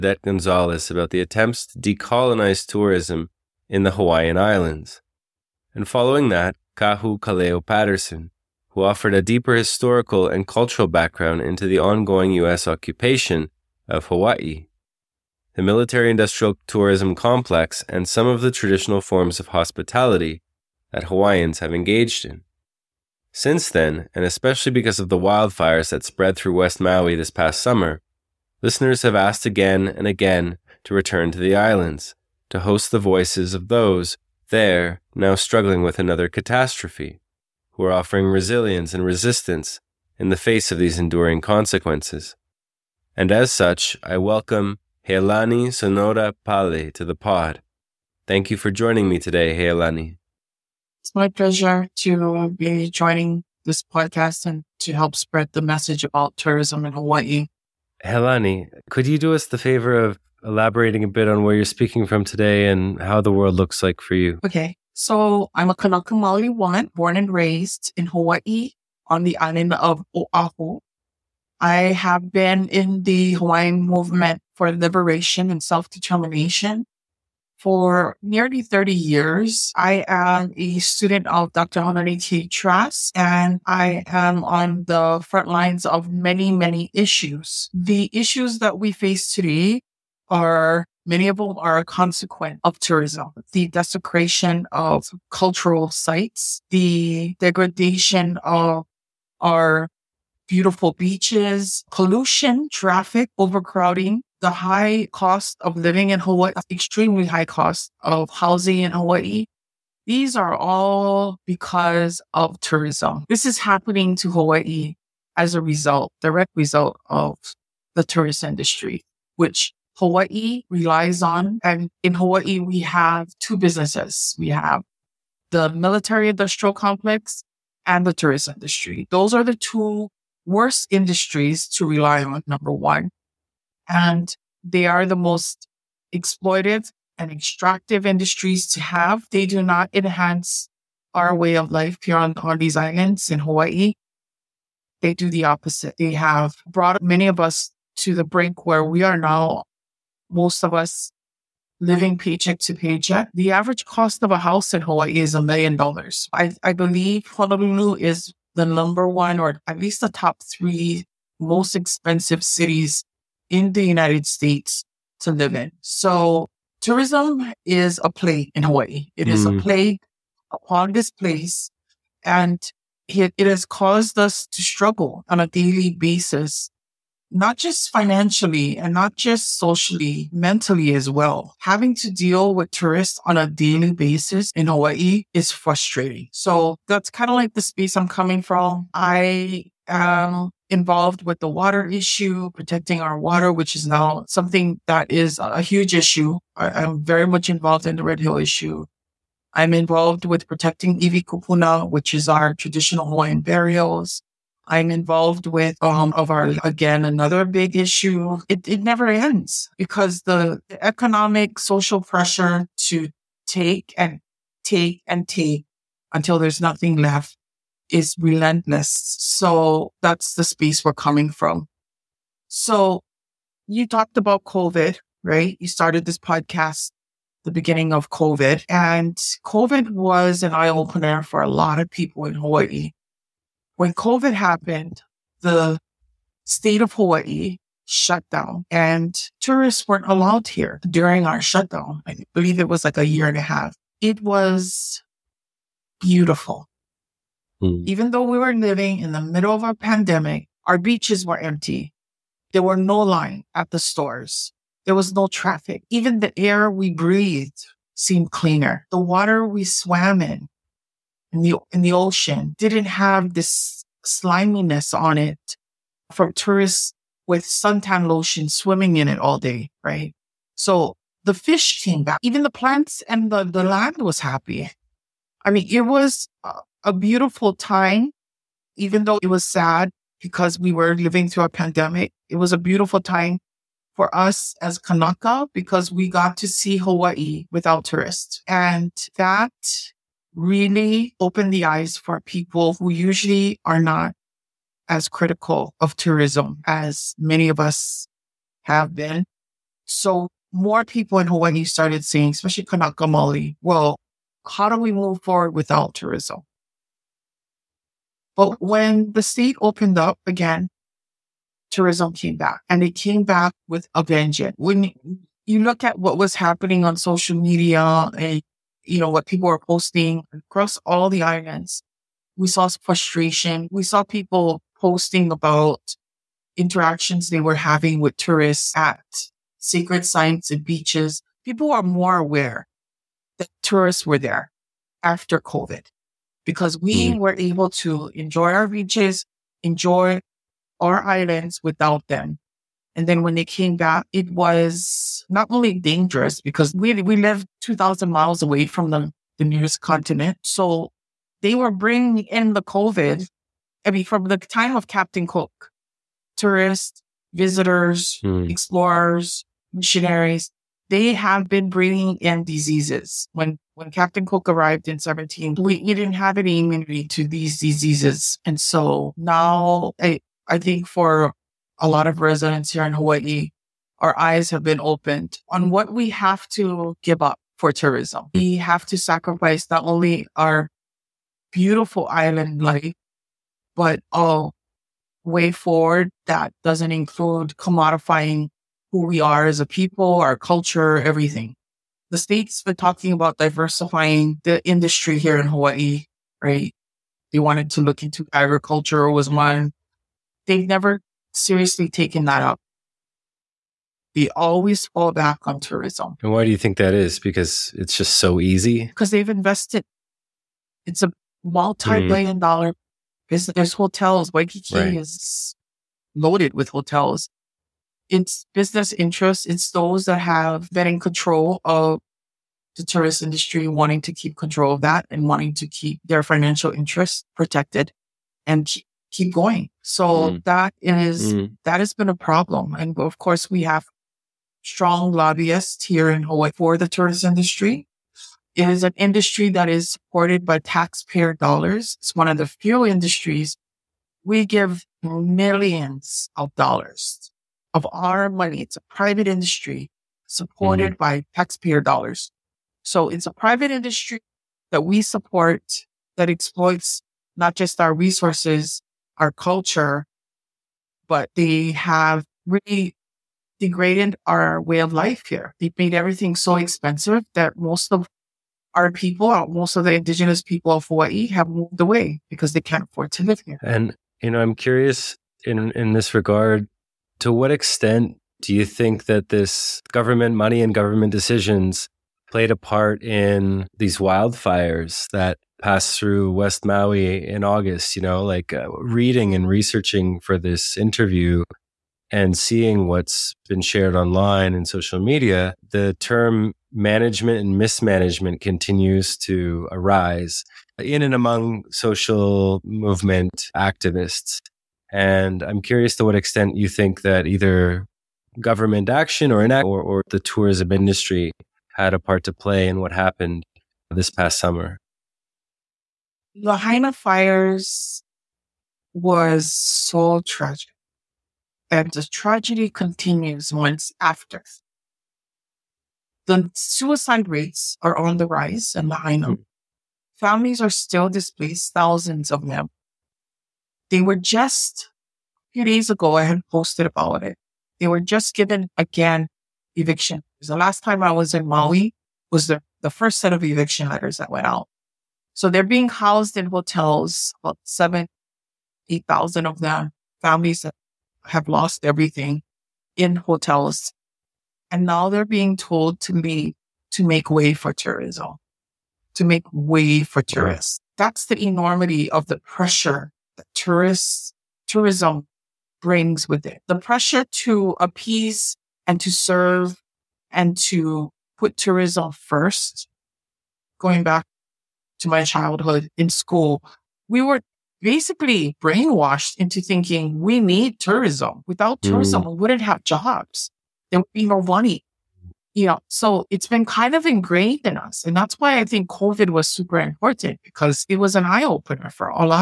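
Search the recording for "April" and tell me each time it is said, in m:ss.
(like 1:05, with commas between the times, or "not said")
not said.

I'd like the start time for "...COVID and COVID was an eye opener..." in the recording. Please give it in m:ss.
3:48.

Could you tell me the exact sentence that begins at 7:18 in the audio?
It is an industry that is supported by taxpayer dollars.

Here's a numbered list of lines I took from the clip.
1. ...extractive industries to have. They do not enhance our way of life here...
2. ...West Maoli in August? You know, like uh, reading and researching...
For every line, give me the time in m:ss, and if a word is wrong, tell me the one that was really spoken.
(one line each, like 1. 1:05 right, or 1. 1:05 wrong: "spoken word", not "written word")
1. 2:17 right
2. 8:06 wrong: "Maui", not "Maoli".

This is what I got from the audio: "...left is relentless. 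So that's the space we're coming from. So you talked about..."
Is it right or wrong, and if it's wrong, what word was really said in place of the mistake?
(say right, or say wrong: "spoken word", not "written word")
right.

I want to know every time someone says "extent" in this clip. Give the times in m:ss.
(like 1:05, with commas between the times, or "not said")
7:57, 8:26.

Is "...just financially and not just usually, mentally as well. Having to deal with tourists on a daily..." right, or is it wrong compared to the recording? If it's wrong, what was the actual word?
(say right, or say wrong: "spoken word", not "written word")
wrong: "socially", not "usually".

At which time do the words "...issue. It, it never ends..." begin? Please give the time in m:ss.
3:27.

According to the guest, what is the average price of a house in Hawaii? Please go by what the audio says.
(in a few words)
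a million dollars.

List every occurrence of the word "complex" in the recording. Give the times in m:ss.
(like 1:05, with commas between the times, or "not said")
0:17, 2:06.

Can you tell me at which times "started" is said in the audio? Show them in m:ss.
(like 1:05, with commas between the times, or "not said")
3:45, 5:01.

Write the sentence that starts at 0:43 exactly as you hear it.
And as such, I welcome Healani Sonoda Pale to the pod.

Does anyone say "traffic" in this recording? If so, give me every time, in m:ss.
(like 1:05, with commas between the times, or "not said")
1:42, 4:15.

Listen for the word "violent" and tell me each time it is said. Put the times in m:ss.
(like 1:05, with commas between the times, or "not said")
not said.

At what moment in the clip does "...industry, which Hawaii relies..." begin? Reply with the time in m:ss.
1:58.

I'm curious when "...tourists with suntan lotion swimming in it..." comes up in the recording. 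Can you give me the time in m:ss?
4:26.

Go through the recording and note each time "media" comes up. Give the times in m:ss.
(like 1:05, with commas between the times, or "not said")
5:17, 8:14.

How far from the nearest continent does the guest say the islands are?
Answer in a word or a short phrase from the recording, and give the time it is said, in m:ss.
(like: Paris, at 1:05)
2,000 miles, at 5:47.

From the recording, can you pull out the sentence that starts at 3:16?
I, am very much involved in the Red Hill issue.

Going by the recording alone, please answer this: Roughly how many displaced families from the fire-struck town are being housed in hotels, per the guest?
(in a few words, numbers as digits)
7,000 to 8,000.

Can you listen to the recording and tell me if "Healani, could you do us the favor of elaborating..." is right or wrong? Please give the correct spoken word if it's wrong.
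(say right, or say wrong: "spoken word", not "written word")
right.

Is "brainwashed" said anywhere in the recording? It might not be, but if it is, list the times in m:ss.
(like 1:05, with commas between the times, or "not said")
9:38.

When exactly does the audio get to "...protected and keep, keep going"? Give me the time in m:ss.
7:07.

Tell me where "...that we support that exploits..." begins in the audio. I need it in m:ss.
7:34.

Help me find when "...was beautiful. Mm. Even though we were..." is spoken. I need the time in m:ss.
4:04.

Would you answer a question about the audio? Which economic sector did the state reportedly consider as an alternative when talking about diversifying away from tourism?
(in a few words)
agriculture.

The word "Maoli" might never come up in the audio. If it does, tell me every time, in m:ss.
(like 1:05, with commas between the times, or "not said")
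1:06, 5:03.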